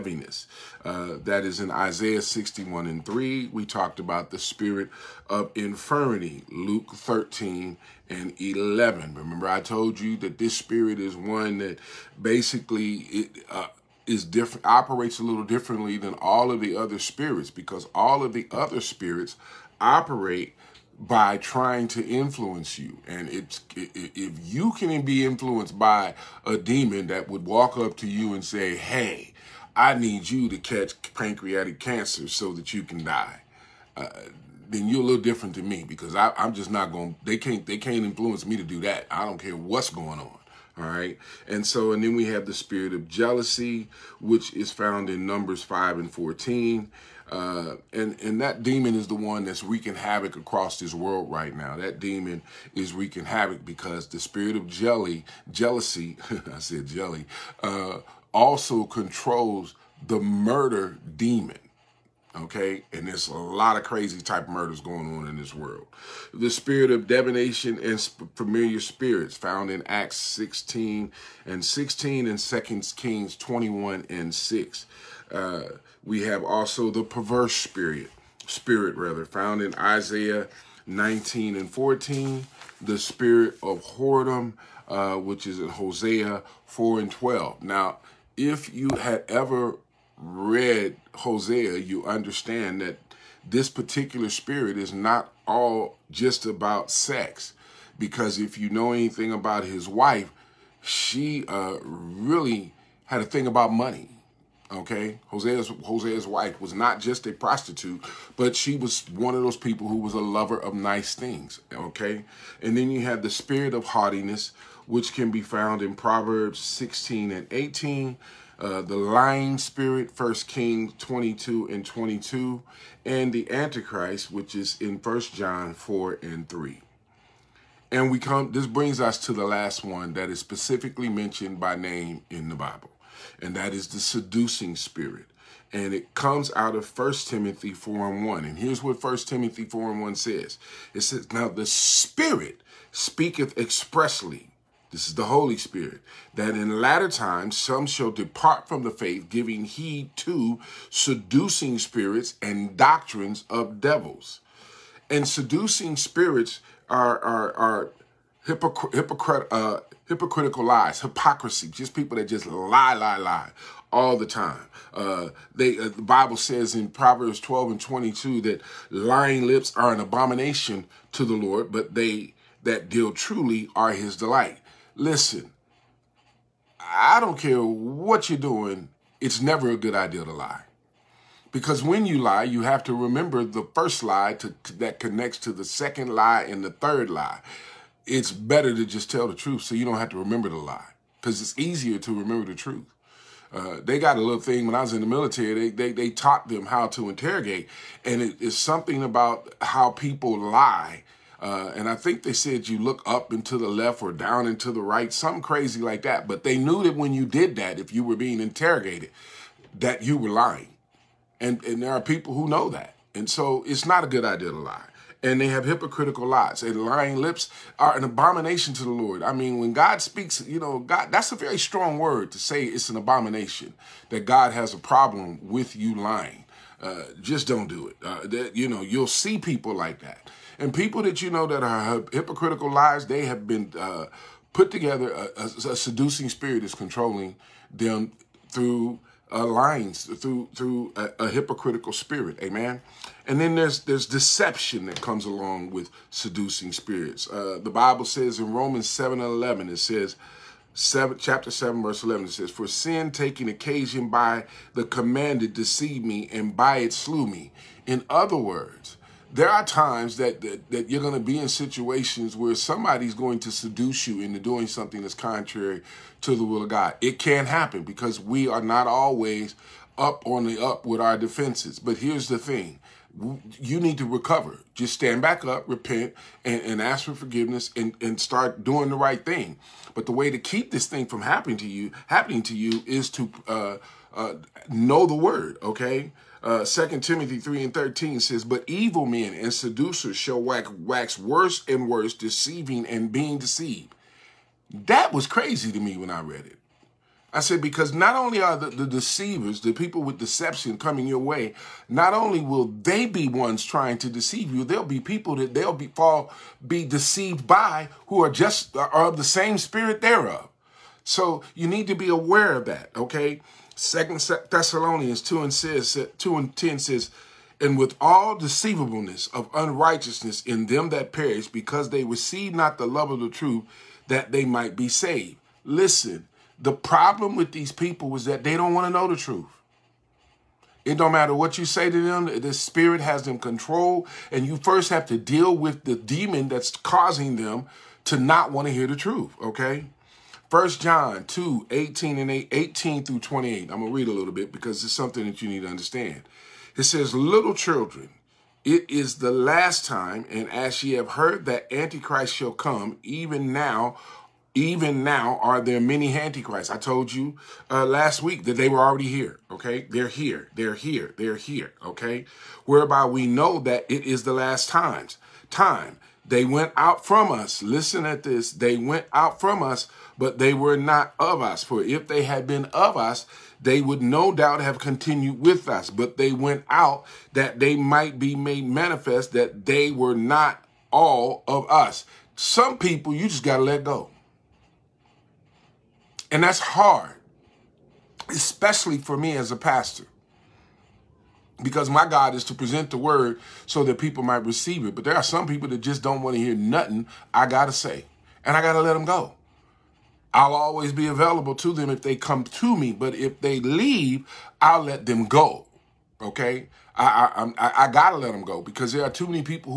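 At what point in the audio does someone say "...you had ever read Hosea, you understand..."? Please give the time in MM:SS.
01:28.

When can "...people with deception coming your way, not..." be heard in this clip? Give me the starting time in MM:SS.
04:59.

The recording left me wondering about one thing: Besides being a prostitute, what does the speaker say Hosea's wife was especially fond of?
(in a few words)
money.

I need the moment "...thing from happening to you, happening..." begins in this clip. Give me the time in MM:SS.
04:40.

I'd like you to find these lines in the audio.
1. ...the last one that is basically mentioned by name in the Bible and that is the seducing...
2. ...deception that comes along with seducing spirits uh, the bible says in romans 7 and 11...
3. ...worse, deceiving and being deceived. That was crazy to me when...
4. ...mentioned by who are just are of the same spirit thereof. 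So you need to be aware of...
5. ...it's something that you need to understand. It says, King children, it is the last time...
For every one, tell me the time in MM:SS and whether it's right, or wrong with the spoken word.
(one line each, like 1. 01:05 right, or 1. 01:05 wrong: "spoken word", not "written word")
1. 02:09 wrong: "specifically", not "basically"
2. 04:04 right
3. 04:51 right
4. 05:06 wrong: "deceived", not "mentioned"
5. 05:44 wrong: "Little", not "King".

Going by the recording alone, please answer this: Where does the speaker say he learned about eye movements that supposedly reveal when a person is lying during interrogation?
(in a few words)
the military.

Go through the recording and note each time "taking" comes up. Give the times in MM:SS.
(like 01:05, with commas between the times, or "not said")
04:13.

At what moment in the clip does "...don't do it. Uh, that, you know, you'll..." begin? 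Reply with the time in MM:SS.
03:47.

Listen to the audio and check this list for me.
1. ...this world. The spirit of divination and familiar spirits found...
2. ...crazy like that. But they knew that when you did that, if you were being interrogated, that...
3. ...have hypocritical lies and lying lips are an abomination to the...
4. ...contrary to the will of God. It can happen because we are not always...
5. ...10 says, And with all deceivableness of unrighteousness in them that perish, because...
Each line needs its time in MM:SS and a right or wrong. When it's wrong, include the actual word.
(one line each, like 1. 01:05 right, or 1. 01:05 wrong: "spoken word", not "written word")
1. 01:05 right
2. 03:25 right
3. 03:35 right
4. 04:25 right
5. 05:16 right.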